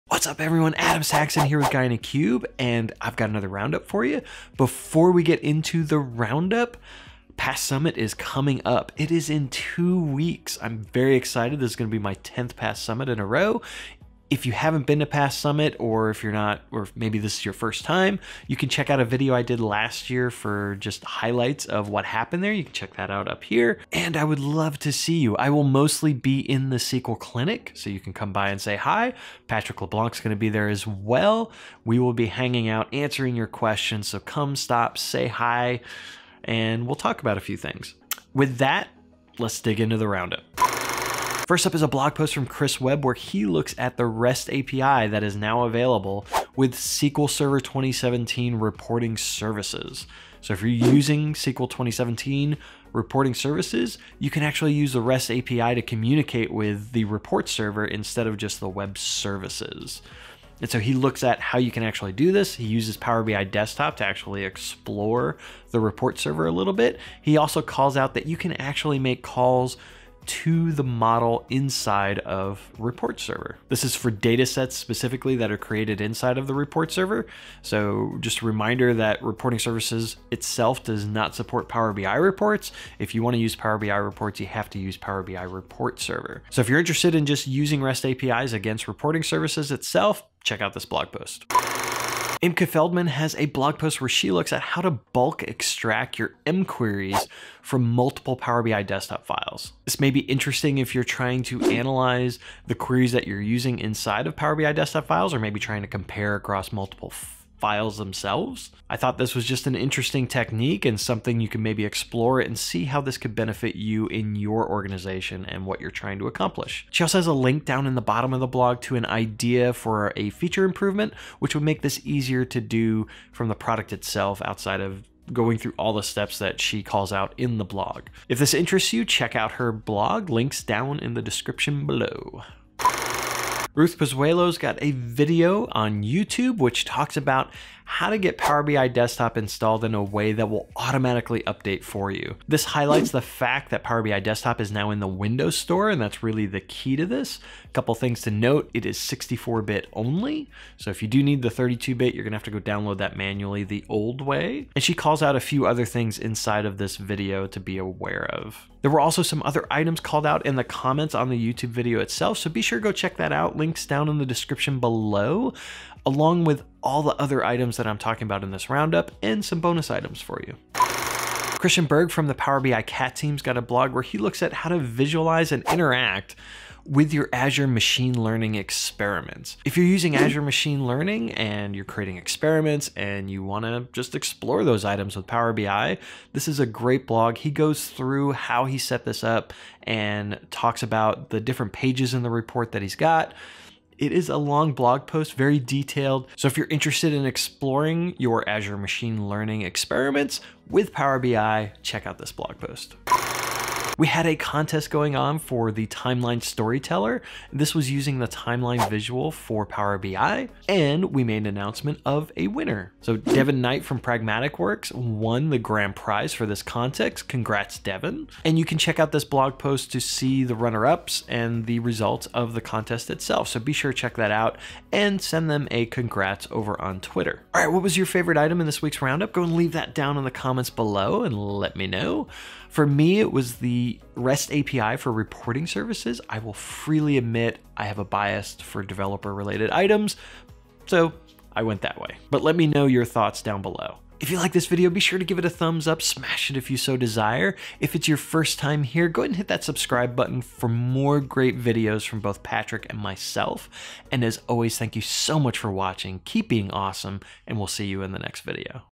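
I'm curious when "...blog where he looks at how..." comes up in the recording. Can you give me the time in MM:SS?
02:53.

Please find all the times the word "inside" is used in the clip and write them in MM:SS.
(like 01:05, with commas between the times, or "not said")
01:11, 01:16, 01:43, 02:36.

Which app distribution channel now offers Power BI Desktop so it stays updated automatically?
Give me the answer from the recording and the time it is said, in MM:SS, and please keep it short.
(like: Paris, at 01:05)
Windows Store, at 02:25.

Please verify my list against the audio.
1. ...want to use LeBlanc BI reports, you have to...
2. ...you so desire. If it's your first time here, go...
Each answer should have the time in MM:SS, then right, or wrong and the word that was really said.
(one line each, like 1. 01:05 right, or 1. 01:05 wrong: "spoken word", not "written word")
1. 01:23 wrong: "Power", not "LeBlanc"
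2. 04:06 right.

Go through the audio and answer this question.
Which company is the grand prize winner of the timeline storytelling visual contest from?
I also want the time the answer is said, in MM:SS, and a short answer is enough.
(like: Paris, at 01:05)
Pragmatic Works, at 03:33.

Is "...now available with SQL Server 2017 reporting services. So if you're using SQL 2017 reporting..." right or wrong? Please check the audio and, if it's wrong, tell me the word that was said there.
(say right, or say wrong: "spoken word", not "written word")
right.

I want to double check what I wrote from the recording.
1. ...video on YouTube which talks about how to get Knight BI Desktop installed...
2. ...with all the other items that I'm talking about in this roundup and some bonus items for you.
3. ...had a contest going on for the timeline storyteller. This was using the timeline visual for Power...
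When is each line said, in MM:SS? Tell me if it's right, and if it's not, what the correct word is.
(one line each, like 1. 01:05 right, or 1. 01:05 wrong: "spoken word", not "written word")
1. 02:14 wrong: "Power", not "Knight"
2. 02:46 right
3. 03:24 right.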